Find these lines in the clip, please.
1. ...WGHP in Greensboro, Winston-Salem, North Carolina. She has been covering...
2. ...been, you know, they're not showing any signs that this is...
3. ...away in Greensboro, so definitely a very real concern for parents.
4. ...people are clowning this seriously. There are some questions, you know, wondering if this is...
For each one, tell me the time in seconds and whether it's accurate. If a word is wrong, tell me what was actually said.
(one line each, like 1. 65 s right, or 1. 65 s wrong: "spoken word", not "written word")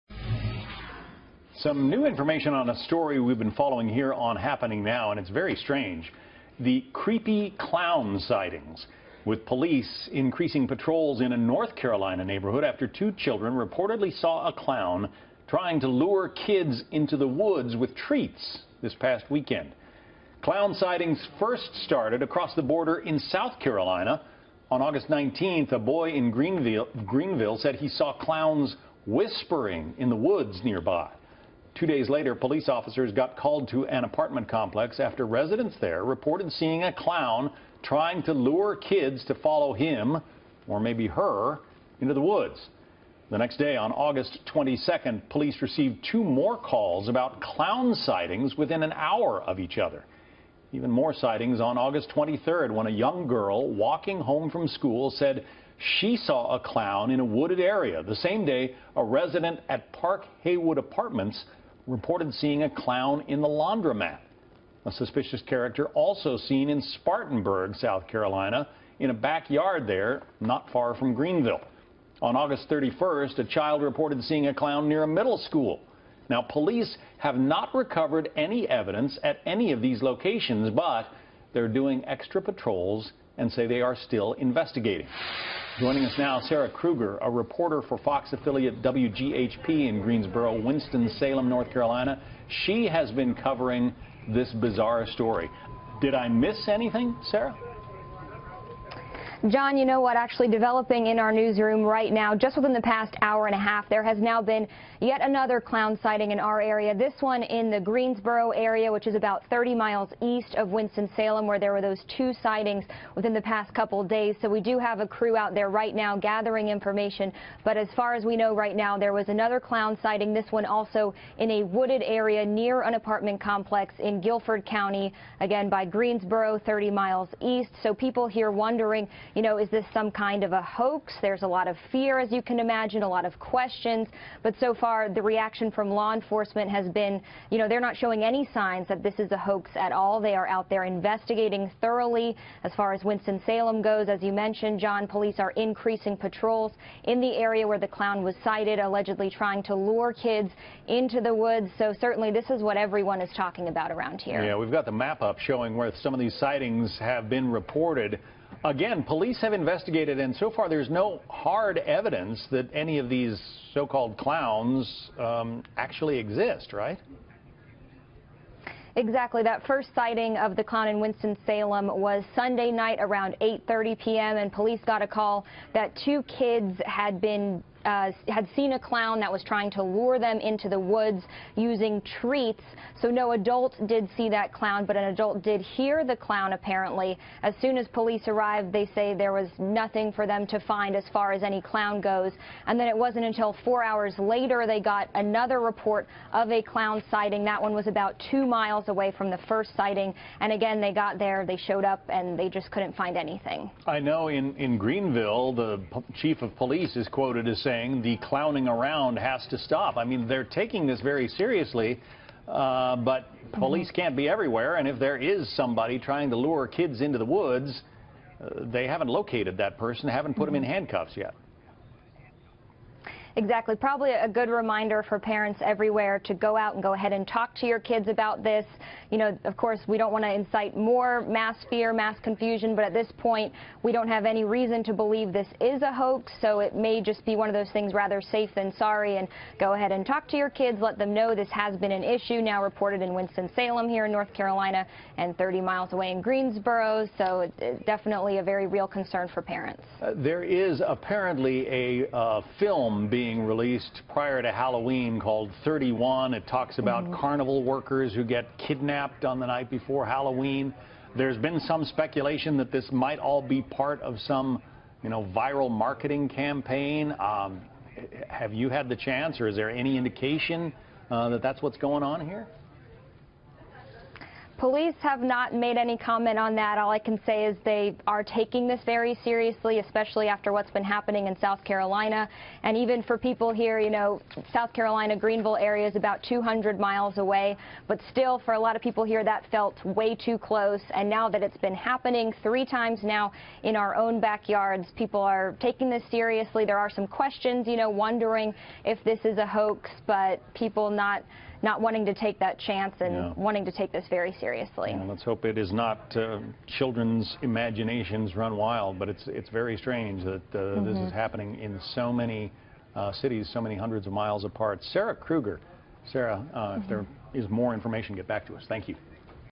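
1. 88 s right
2. 136 s right
3. 245 s right
4. 294 s wrong: "taking", not "clowning".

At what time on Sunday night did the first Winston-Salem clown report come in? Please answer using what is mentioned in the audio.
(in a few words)
8:30 p.m.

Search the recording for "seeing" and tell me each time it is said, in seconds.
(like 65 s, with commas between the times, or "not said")
36 s, 62 s, 74 s.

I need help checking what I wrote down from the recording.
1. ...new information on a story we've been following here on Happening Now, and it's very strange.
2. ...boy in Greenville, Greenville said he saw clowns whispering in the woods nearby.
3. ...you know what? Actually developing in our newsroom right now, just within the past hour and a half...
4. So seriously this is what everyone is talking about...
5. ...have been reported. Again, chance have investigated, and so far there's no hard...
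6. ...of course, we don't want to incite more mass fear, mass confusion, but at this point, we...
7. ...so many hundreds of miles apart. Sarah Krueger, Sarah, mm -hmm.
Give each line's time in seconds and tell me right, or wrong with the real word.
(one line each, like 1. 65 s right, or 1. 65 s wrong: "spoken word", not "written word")
1. 1 s right
2. 25 s right
3. 99 s right
4. 151 s wrong: "certainly", not "seriously"
5. 156 s wrong: "police", not "chance"
6. 229 s right
7. 313 s right.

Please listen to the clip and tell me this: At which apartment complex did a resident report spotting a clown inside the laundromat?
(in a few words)
Park Haywood Apartments.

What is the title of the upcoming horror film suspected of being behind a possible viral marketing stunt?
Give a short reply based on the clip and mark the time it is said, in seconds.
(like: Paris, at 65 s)
31, at 255 s.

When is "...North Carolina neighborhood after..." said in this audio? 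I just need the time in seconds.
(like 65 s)
11 s.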